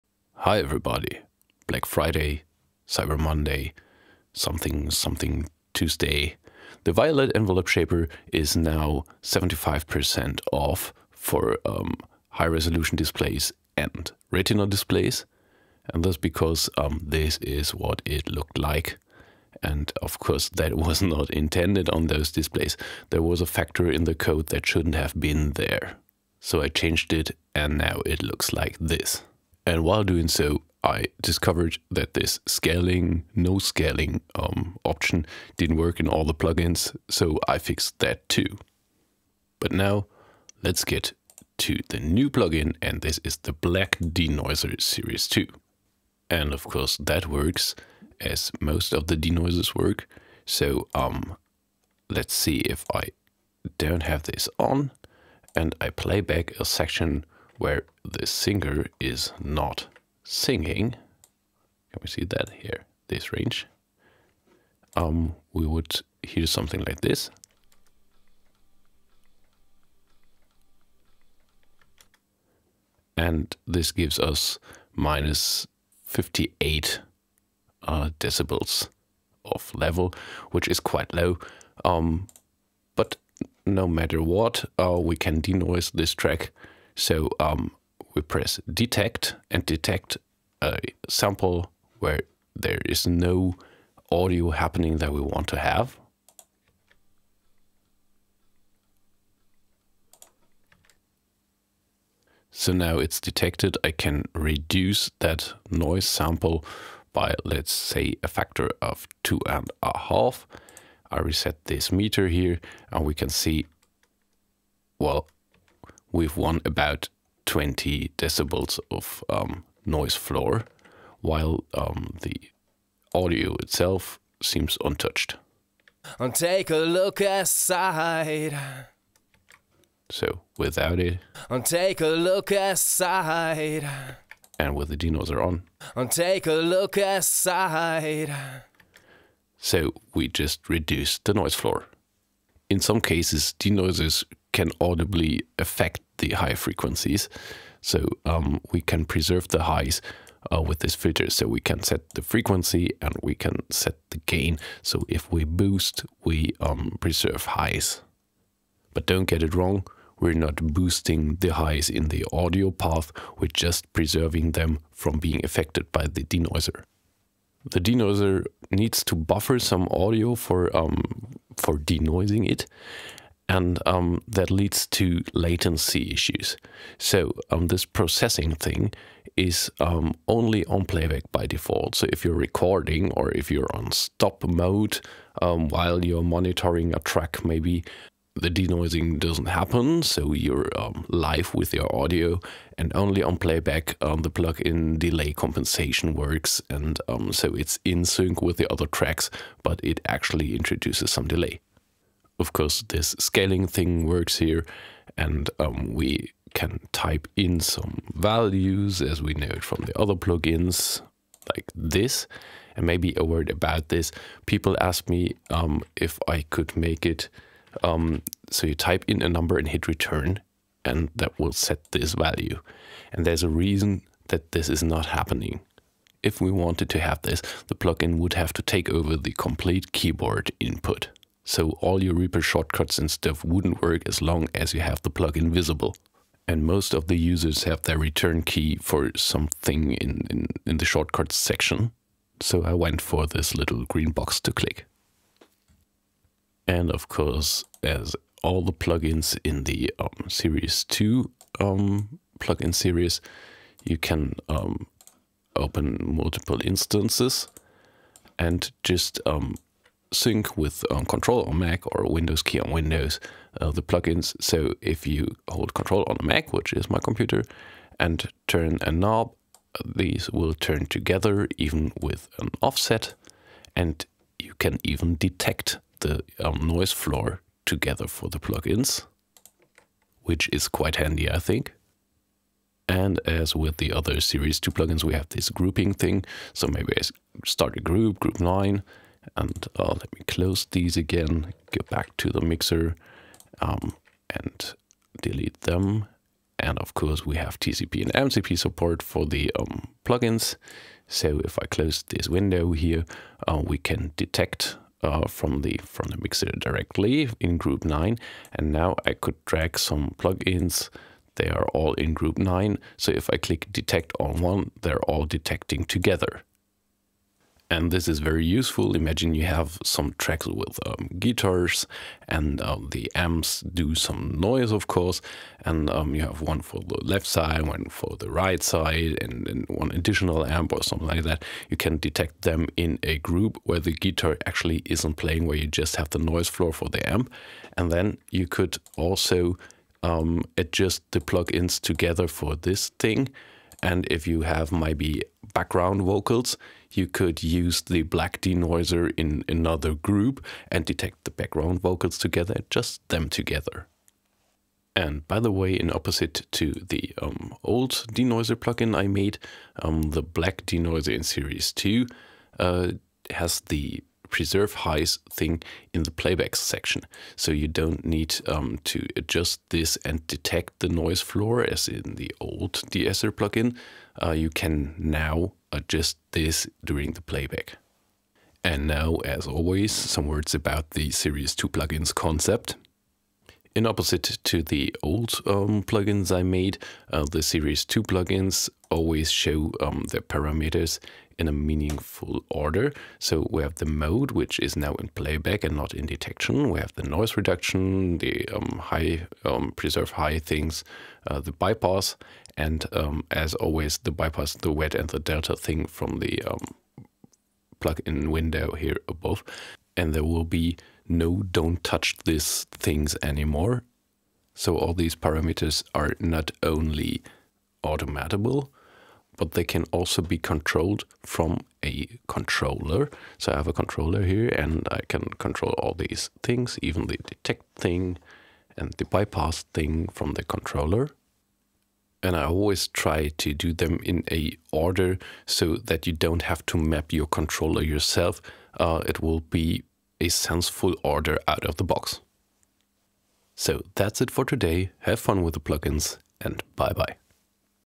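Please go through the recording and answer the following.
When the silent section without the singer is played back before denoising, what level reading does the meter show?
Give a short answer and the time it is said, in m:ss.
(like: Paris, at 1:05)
-58 dB, at 1:14.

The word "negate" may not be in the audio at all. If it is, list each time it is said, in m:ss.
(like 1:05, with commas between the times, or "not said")
not said.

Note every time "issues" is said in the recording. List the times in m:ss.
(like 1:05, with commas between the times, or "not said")
2:56.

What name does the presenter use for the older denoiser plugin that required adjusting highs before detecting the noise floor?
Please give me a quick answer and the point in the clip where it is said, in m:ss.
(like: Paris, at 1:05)
DSR, at 6:12.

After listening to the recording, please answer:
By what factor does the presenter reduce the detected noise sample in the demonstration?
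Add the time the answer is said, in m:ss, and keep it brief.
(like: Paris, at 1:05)
2.5, at 1:49.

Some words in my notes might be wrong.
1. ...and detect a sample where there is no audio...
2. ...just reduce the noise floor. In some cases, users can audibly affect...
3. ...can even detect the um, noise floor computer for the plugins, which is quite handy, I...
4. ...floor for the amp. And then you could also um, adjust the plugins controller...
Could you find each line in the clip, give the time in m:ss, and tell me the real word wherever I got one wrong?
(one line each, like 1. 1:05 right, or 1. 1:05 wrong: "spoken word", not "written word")
1. 1:29 right
2. 2:20 wrong: "denoisers", not "users"
3. 4:34 wrong: "together", not "computer"
4. 5:36 wrong: "together", not "controller".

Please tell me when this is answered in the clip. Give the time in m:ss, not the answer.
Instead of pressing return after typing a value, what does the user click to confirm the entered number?
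4:03.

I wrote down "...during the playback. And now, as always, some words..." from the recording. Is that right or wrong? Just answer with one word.
right.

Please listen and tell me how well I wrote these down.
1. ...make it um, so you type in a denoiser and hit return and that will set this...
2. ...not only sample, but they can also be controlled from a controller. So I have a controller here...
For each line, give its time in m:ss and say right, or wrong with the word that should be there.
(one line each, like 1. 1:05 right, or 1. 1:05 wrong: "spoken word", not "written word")
1. 3:36 wrong: "number", not "denoiser"
2. 6:56 wrong: "automatable", not "sample".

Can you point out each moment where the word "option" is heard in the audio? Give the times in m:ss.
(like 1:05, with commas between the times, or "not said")
0:34.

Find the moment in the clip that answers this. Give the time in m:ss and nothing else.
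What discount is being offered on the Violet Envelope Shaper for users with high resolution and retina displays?
0:09.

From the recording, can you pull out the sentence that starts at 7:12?
And I always try to do them in a order so that you don't have to map your controller yourself.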